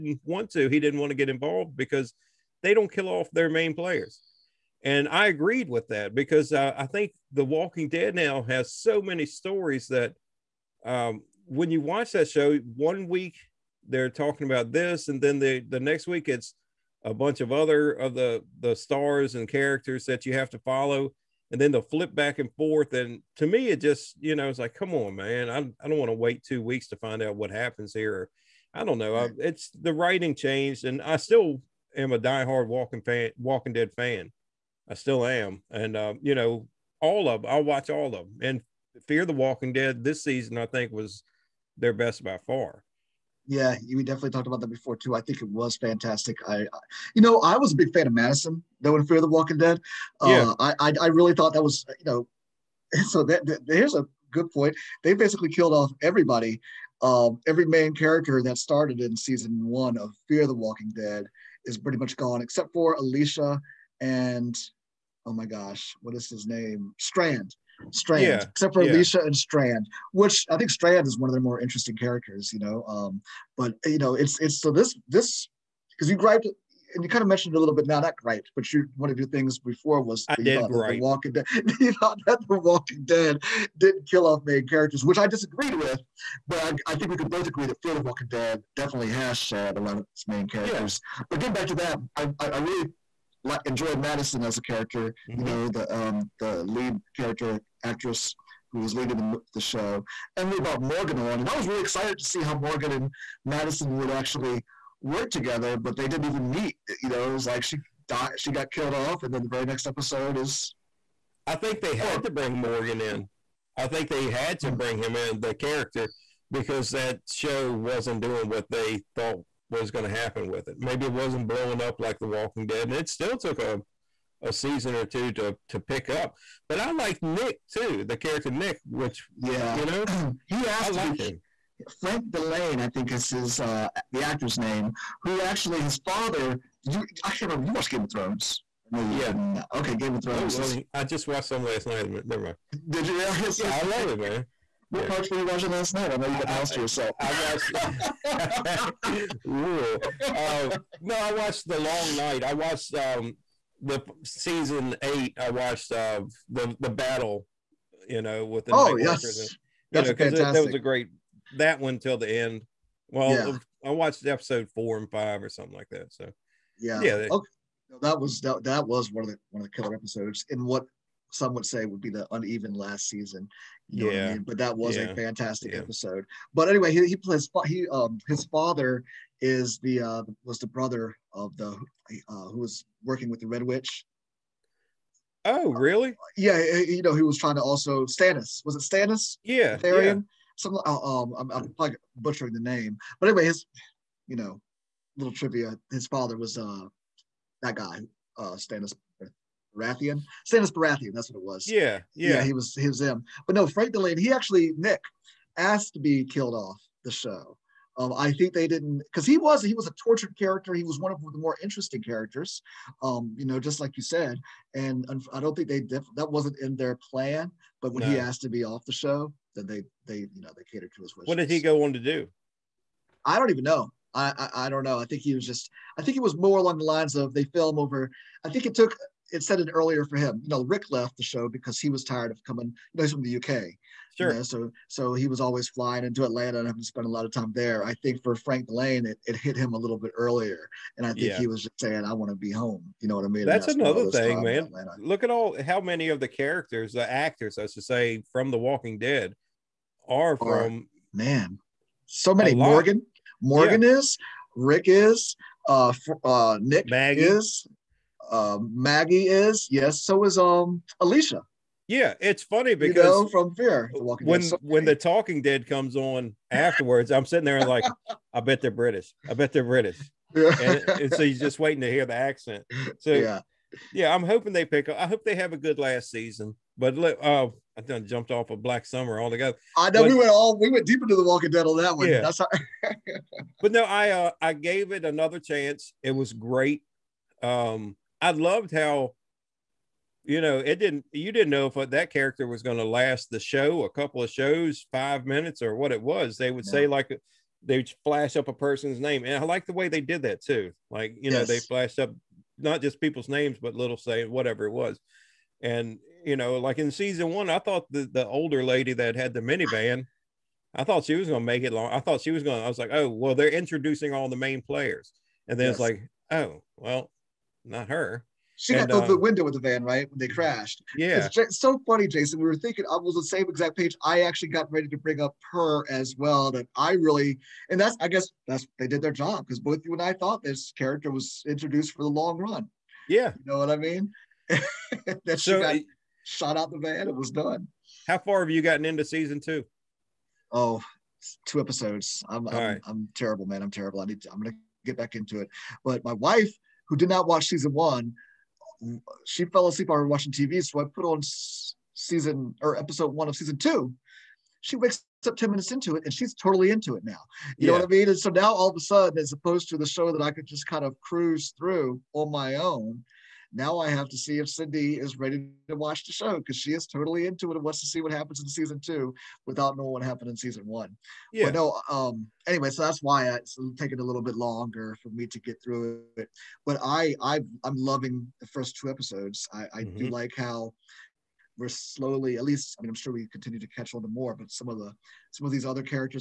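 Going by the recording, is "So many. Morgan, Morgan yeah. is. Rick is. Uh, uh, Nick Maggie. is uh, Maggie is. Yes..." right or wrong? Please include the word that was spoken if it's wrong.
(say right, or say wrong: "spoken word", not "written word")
right.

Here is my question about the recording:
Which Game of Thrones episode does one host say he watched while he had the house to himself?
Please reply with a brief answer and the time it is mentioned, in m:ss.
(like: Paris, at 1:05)
The Long Night, at 2:31.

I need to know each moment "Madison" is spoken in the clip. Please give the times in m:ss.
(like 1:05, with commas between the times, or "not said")
0:48, 1:34, 1:43.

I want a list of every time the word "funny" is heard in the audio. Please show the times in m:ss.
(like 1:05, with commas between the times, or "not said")
4:22, 5:21.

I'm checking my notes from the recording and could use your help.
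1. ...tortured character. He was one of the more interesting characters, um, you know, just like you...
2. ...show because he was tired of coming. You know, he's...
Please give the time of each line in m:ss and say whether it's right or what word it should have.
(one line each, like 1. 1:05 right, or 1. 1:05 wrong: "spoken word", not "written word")
1. 3:30 right
2. 3:51 right.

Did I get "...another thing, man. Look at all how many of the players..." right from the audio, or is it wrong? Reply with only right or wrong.
wrong.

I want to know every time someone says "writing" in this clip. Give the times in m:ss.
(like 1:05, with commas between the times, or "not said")
0:29.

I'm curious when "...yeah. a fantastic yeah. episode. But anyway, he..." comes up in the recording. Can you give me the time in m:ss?
2:54.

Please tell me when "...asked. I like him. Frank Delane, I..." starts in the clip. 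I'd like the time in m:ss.
2:10.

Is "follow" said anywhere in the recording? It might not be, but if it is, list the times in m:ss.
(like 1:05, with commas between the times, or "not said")
0:20.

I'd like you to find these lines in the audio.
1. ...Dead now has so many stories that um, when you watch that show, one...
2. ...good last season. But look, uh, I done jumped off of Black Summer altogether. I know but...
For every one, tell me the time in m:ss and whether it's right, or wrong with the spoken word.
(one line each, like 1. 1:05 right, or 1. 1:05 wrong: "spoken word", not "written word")
1. 0:07 right
2. 4:35 right.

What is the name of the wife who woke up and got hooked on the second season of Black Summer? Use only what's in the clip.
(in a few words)
Cindy.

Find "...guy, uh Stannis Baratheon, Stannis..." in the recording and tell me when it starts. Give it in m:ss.
3:17.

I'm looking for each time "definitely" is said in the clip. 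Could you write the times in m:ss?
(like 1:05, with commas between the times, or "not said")
0:44, 1:28.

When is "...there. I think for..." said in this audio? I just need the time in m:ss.
3:57.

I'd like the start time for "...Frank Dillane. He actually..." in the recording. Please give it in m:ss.
3:23.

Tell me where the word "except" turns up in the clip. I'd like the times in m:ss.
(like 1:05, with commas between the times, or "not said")
1:02, 1:08.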